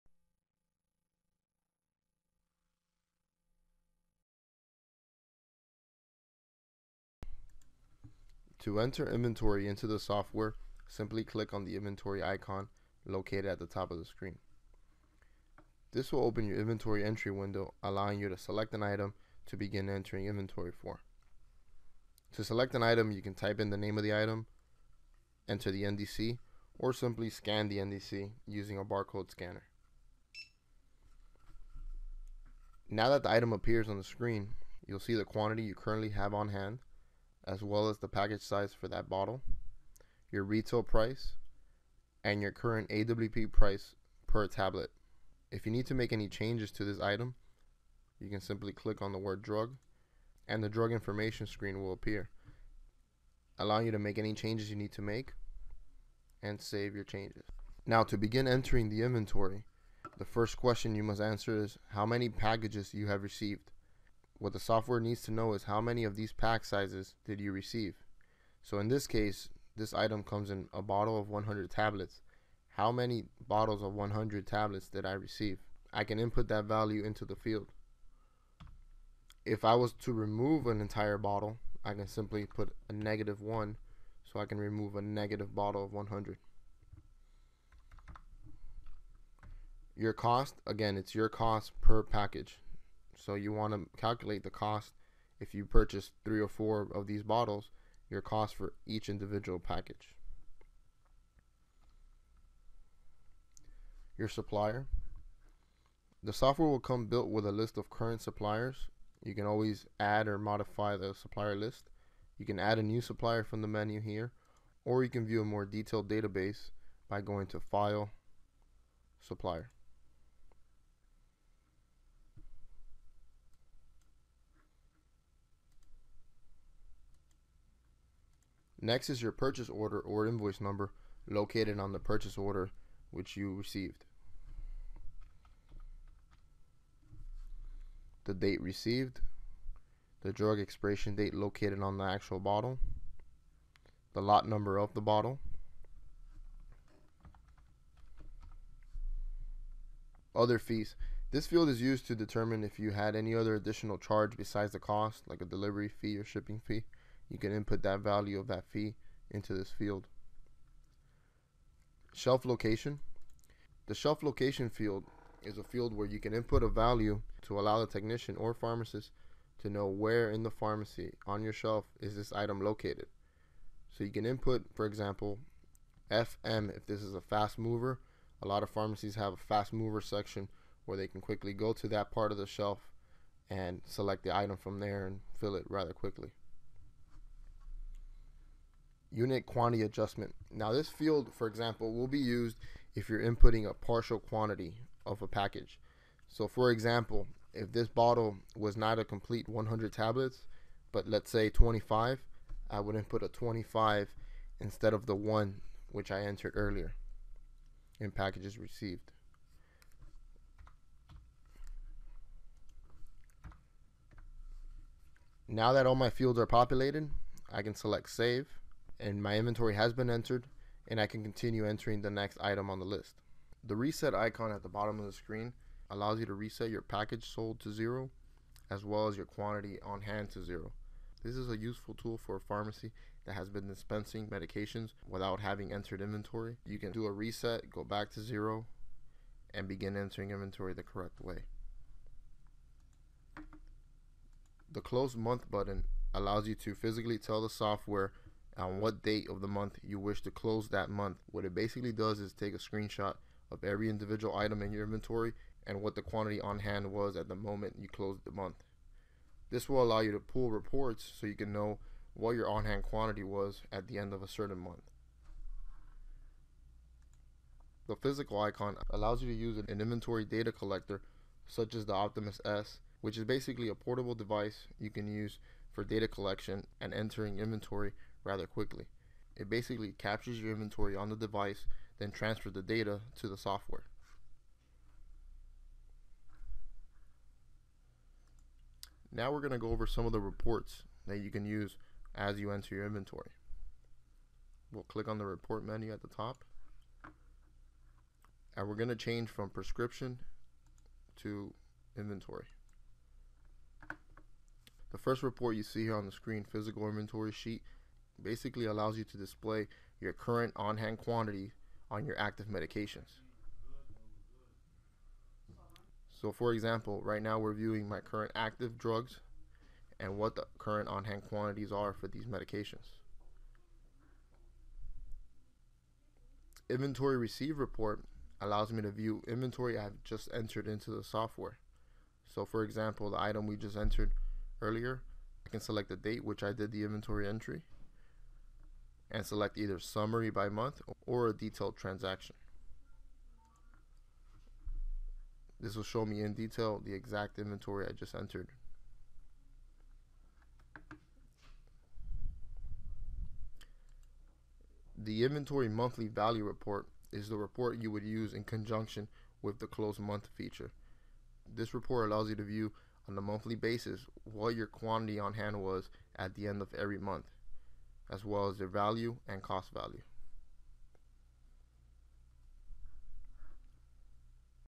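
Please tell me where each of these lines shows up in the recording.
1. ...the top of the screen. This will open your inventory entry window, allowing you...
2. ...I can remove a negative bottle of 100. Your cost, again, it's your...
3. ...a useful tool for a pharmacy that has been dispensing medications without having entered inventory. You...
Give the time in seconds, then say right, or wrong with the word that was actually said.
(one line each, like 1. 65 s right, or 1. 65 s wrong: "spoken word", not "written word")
1. 13 s right
2. 84 s right
3. 231 s right.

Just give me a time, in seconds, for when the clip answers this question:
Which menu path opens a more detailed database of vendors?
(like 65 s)
117 s.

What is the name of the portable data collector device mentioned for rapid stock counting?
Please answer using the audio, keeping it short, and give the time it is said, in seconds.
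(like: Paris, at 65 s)
Optimus S, at 271 s.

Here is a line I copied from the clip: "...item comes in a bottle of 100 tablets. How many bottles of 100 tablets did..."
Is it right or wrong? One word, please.
right.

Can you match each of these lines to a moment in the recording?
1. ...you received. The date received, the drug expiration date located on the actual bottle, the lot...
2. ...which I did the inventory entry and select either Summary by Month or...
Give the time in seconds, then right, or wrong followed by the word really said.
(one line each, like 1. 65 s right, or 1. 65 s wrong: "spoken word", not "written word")
1. 133 s right
2. 336 s right.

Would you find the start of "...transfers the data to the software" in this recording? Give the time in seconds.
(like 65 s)
282 s.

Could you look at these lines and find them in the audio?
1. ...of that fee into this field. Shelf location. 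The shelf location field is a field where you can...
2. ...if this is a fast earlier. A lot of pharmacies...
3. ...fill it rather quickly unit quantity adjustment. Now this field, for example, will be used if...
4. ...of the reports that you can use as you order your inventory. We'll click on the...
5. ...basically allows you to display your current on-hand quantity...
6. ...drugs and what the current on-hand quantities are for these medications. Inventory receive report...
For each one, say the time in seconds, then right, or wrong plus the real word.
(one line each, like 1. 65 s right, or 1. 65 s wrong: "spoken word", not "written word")
1. 158 s right
2. 176 s wrong: "mover", not "earlier"
3. 185 s right
4. 290 s wrong: "enter", not "order"
5. 308 s right
6. 318 s right.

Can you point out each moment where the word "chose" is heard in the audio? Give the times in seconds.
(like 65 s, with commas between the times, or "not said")
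not said.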